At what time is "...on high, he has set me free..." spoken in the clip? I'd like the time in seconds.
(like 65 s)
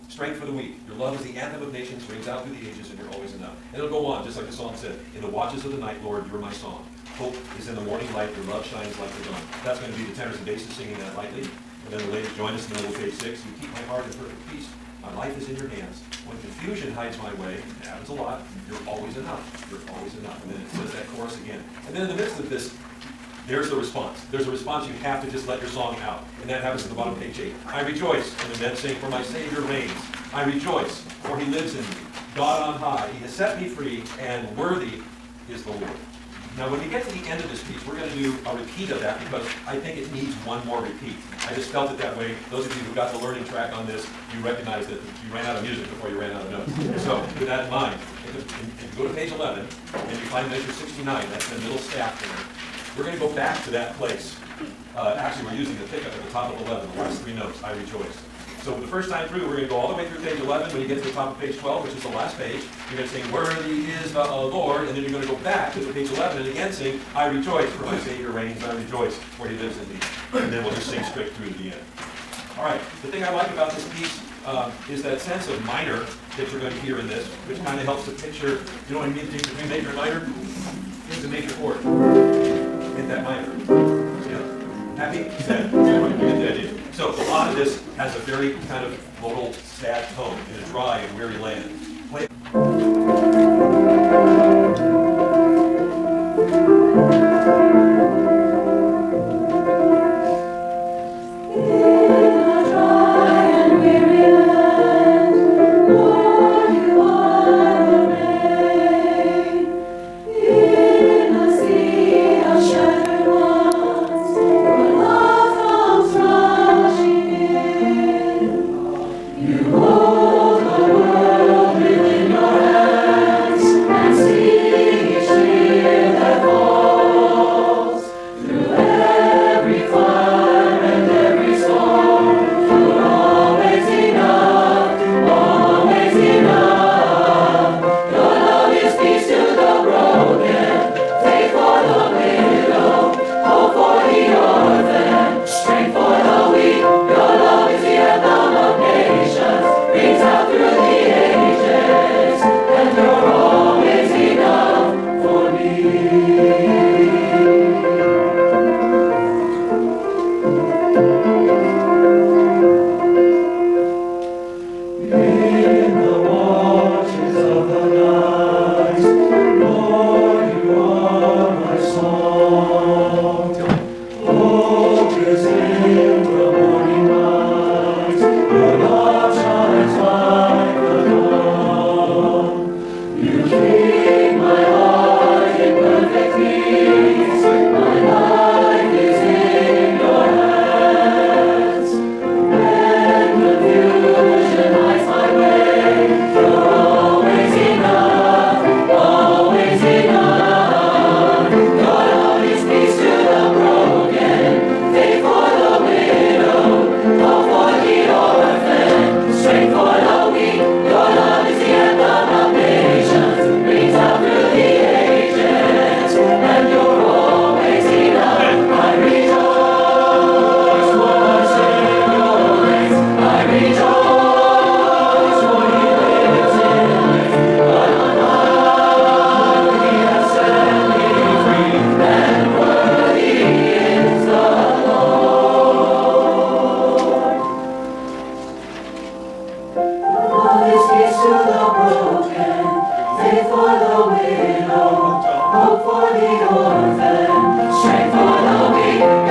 32 s.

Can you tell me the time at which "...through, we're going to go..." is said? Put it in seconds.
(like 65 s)
59 s.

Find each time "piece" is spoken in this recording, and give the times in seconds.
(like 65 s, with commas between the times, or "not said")
37 s, 73 s.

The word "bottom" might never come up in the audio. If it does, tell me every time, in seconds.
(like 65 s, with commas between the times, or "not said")
26 s.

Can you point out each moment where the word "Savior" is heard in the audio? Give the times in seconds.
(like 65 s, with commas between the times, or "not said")
29 s, 67 s.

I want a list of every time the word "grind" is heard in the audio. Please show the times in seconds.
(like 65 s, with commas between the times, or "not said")
not said.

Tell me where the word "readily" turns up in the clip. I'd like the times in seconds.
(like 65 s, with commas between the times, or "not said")
not said.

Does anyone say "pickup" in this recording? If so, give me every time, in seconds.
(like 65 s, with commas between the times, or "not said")
55 s.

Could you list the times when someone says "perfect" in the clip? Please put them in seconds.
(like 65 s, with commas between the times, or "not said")
14 s.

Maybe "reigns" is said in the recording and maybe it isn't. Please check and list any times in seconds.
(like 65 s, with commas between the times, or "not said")
29 s, 68 s.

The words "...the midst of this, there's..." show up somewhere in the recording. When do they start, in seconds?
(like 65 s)
22 s.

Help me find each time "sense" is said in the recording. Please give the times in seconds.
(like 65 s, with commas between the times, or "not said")
75 s.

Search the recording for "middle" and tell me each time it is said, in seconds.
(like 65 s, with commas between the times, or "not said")
12 s, 51 s.